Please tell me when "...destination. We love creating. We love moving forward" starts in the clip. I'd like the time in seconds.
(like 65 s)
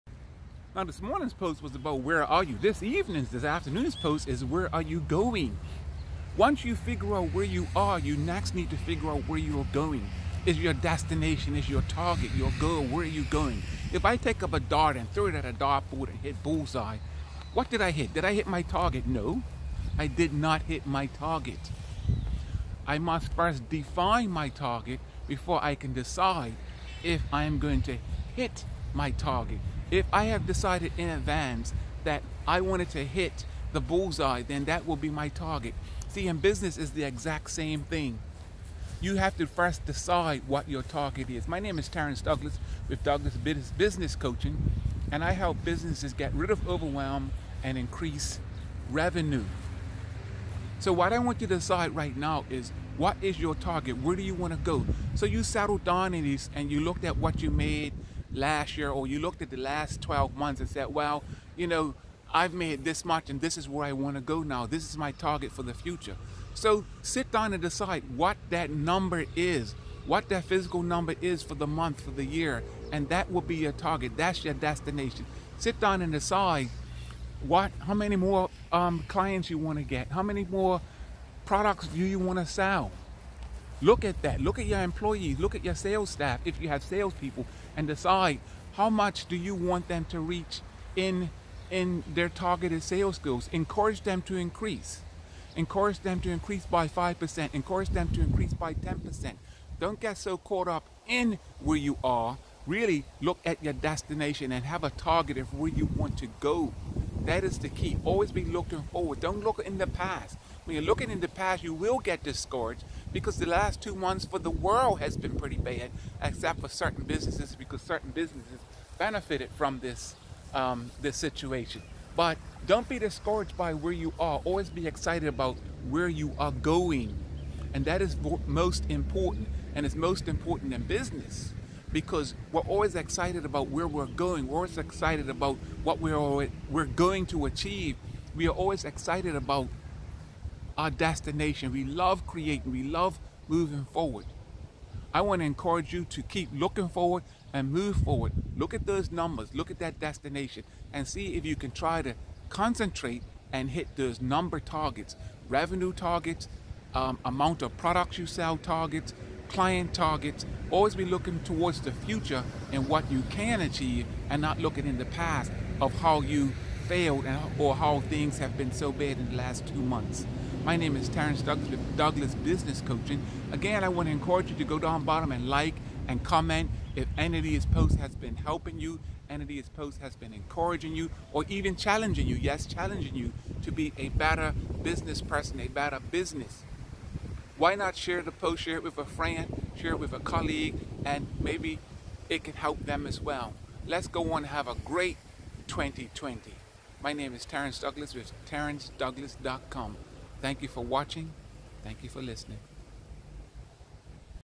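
140 s.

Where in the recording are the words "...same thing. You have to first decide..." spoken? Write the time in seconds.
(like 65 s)
37 s.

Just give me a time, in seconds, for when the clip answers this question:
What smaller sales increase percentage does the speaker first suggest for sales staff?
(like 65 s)
96 s.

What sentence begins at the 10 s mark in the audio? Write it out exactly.
Is your destination, is your target, your goal, where are you going?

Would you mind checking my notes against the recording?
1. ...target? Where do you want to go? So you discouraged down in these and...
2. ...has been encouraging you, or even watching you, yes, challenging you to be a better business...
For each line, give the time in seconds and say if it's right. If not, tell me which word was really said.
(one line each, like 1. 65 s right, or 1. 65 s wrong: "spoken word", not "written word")
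1. 53 s wrong: "settled", not "discouraged"
2. 180 s wrong: "challenging", not "watching".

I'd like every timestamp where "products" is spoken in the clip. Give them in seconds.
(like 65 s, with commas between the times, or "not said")
81 s, 157 s.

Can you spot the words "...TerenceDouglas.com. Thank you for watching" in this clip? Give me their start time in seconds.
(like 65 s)
198 s.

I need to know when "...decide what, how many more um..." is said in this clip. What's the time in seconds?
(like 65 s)
76 s.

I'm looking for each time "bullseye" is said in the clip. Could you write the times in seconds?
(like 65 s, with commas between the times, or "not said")
16 s, 33 s.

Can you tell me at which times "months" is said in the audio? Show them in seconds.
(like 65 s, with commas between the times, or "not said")
60 s, 71 s, 113 s, 169 s.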